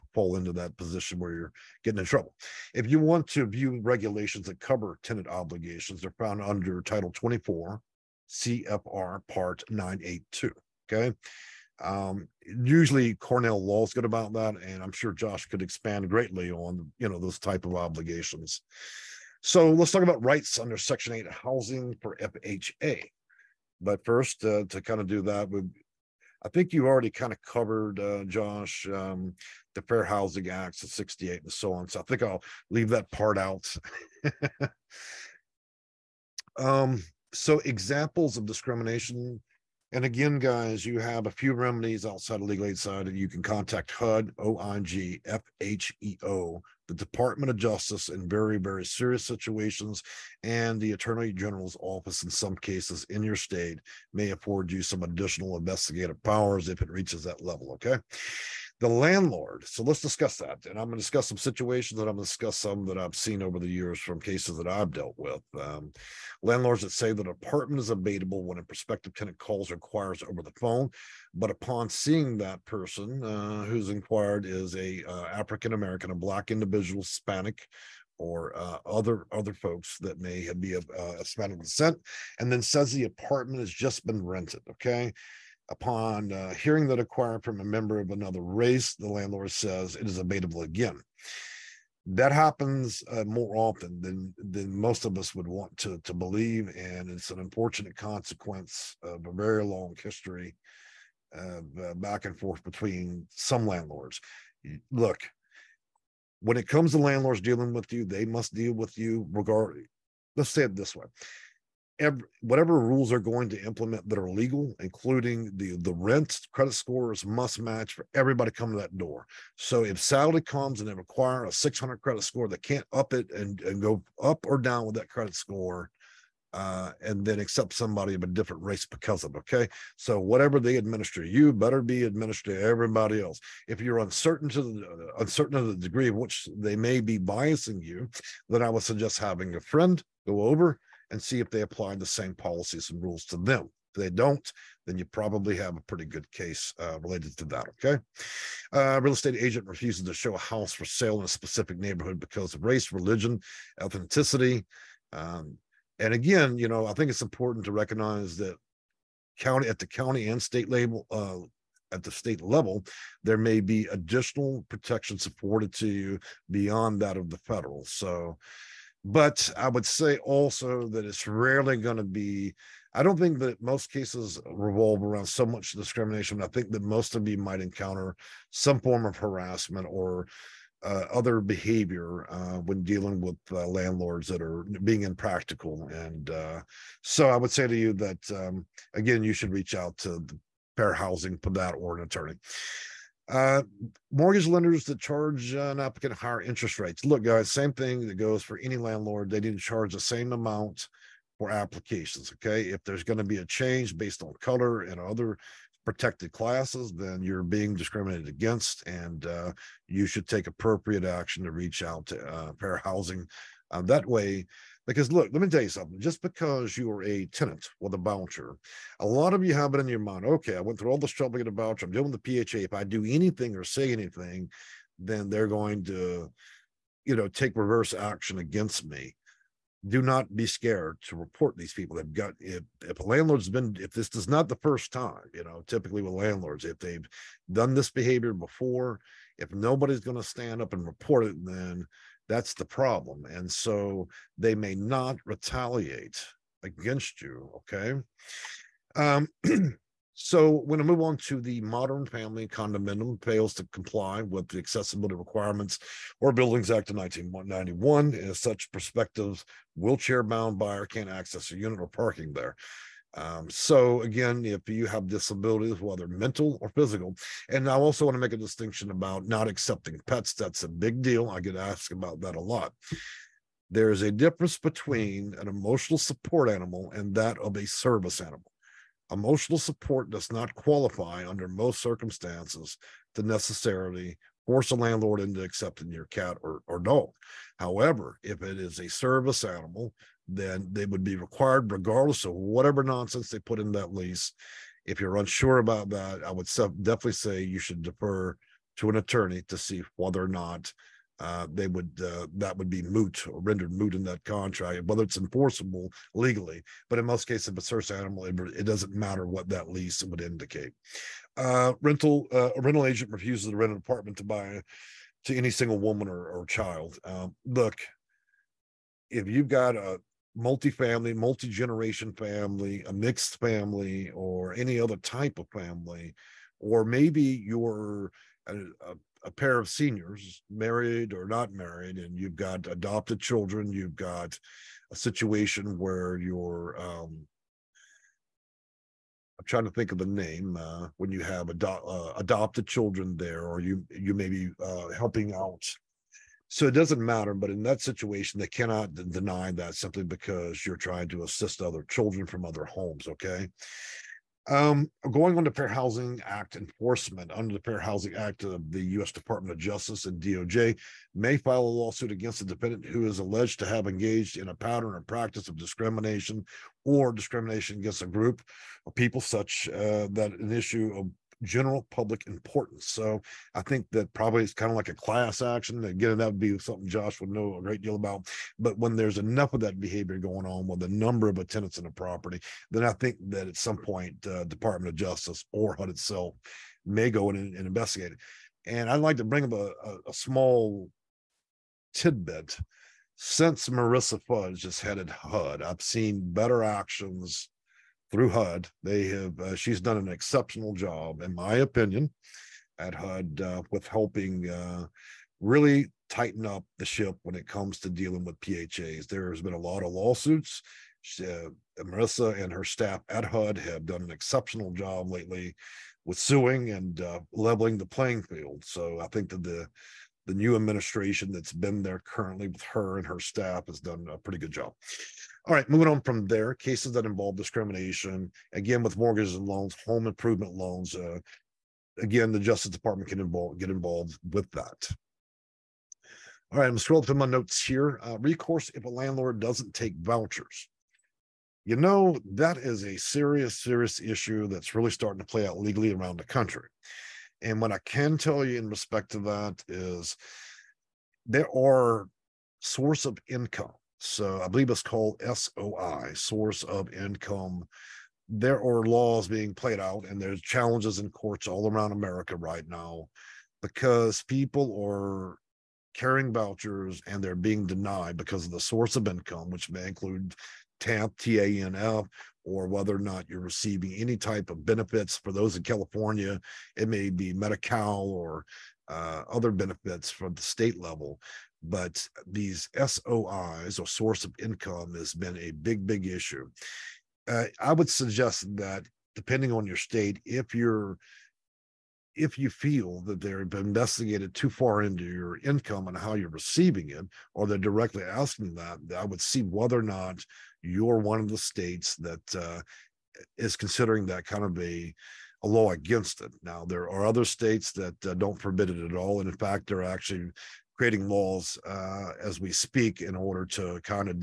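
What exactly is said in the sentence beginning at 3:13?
Uh, mortgage lenders that charge an applicant higher interest rates.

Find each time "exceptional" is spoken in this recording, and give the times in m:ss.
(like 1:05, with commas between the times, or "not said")
6:40, 6:54.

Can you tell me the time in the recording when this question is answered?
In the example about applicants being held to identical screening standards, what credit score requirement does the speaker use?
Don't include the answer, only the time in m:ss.
2:01.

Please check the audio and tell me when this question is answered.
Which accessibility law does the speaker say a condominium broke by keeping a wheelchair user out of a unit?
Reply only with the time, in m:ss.
4:16.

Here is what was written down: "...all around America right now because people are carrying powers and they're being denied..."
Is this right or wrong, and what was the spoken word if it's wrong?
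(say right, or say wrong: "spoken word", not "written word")
wrong: "vouchers", not "powers".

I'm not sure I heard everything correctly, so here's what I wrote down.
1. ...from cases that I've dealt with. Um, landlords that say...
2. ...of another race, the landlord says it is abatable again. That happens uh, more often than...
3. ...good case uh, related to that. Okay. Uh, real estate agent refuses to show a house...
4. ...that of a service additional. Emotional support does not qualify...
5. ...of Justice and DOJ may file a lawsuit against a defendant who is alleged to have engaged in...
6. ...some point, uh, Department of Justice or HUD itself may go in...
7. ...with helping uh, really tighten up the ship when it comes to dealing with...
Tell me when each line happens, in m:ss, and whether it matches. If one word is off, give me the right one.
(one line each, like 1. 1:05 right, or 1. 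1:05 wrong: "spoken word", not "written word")
1. 1:03 right
2. 1:27 right
3. 2:26 right
4. 4:37 wrong: "animal", not "additional"
5. 5:59 right
6. 6:23 right
7. 6:43 right.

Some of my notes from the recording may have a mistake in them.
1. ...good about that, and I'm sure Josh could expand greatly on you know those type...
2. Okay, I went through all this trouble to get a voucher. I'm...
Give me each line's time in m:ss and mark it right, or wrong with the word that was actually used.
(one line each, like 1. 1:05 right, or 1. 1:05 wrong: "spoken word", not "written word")
1. 0:13 right
2. 3:40 right.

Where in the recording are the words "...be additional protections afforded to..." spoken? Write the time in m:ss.
2:43.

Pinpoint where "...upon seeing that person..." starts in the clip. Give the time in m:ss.
1:11.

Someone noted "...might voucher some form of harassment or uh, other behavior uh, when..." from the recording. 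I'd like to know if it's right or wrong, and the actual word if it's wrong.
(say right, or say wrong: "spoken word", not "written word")
wrong: "encounter", not "voucher".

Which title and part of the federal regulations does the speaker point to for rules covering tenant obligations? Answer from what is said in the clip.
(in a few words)
Title 24, CFR Part 982.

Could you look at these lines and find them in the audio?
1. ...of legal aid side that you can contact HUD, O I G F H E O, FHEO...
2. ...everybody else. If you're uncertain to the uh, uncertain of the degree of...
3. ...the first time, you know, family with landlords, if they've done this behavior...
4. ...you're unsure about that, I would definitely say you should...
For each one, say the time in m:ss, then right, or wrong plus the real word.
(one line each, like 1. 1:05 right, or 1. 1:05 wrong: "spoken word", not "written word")
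1. 0:42 right
2. 2:12 right
3. 3:54 wrong: "typically", not "family"
4. 4:54 right.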